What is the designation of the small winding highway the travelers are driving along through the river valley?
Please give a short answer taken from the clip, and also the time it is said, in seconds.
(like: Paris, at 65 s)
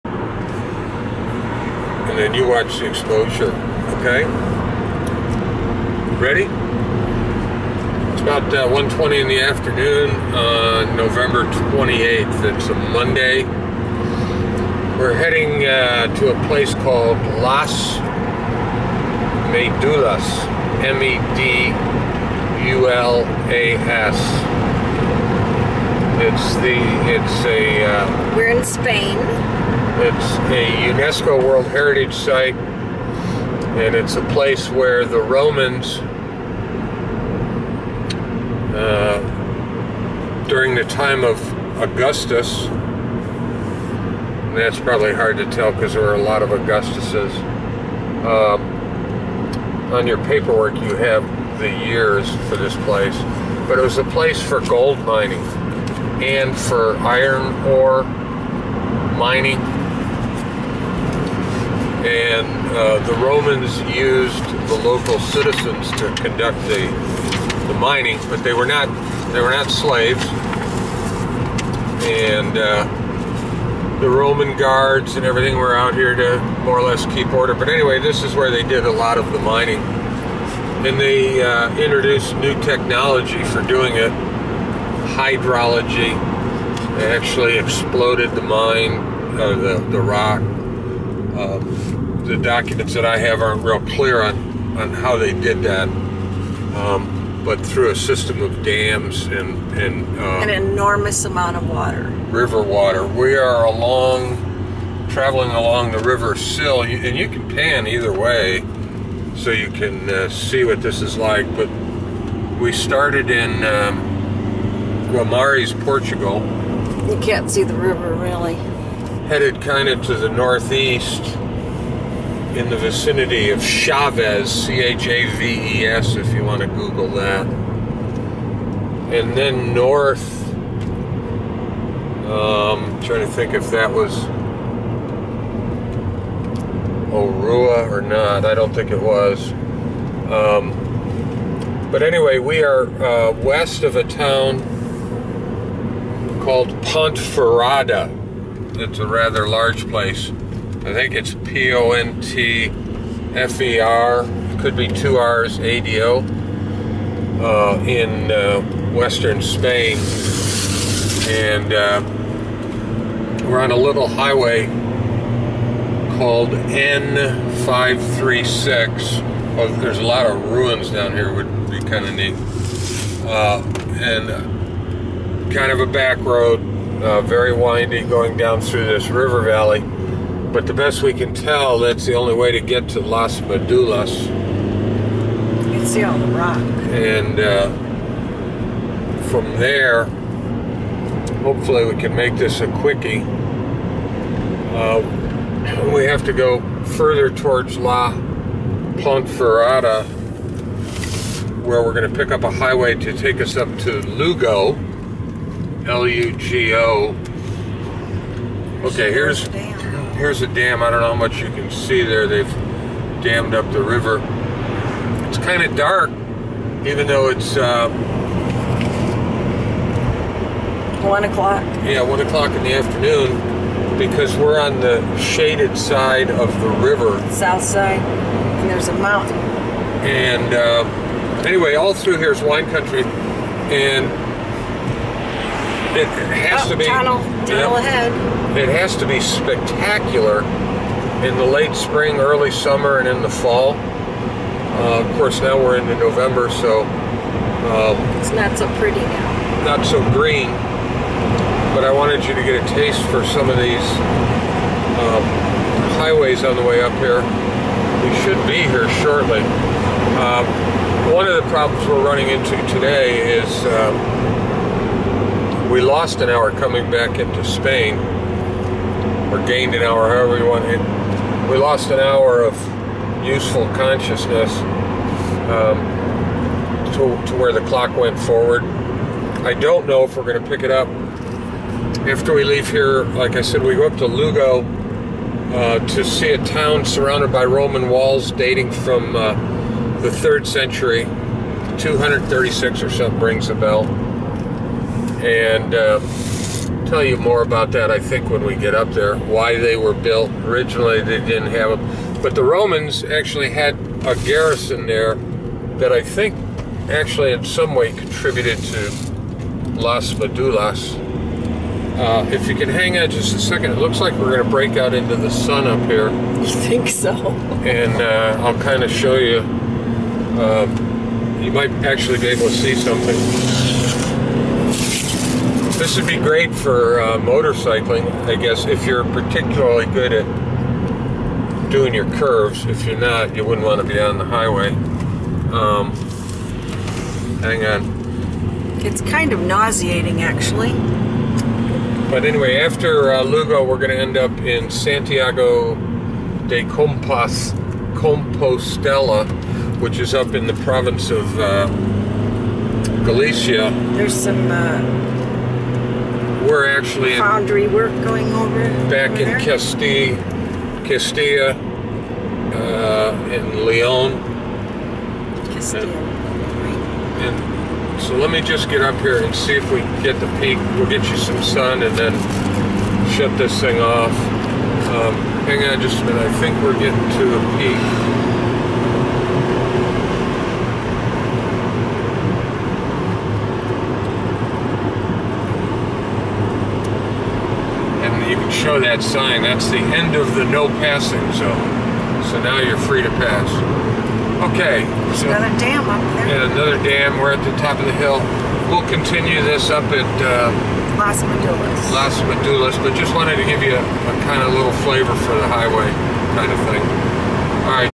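N536, at 166 s.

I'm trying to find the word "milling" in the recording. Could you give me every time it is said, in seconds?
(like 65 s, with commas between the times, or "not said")
not said.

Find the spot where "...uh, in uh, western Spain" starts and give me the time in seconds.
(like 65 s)
157 s.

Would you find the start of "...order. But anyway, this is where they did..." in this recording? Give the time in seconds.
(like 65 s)
77 s.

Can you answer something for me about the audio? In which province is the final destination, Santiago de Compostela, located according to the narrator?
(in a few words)
Galicia.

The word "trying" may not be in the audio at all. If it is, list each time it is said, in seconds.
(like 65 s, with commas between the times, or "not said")
133 s.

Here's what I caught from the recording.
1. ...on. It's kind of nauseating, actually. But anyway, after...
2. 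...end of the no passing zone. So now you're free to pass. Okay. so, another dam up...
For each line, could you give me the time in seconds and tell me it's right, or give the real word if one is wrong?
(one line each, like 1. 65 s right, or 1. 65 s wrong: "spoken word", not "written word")
1. 337 s right
2. 389 s right.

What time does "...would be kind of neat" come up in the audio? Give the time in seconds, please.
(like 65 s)
171 s.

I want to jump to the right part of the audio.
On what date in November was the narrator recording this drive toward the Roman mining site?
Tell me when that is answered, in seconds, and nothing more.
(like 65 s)
10 s.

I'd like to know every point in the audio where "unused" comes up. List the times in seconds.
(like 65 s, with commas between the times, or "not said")
not said.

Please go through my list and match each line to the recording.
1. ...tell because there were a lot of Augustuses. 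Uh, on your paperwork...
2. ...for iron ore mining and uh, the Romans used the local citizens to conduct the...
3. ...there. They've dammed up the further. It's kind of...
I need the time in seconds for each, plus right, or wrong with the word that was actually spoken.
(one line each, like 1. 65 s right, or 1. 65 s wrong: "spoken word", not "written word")
1. 45 s right
2. 56 s right
3. 212 s wrong: "river", not "further".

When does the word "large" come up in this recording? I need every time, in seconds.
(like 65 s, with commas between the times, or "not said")
149 s.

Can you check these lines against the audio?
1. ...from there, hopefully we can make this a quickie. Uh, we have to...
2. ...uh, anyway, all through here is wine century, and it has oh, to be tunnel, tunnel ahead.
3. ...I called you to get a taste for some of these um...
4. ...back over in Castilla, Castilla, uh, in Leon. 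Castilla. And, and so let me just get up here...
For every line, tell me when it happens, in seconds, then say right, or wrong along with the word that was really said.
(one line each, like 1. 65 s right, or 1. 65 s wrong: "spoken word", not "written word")
1. 189 s right
2. 230 s wrong: "country", not "century"
3. 251 s wrong: "wanted", not "called"
4. 358 s right.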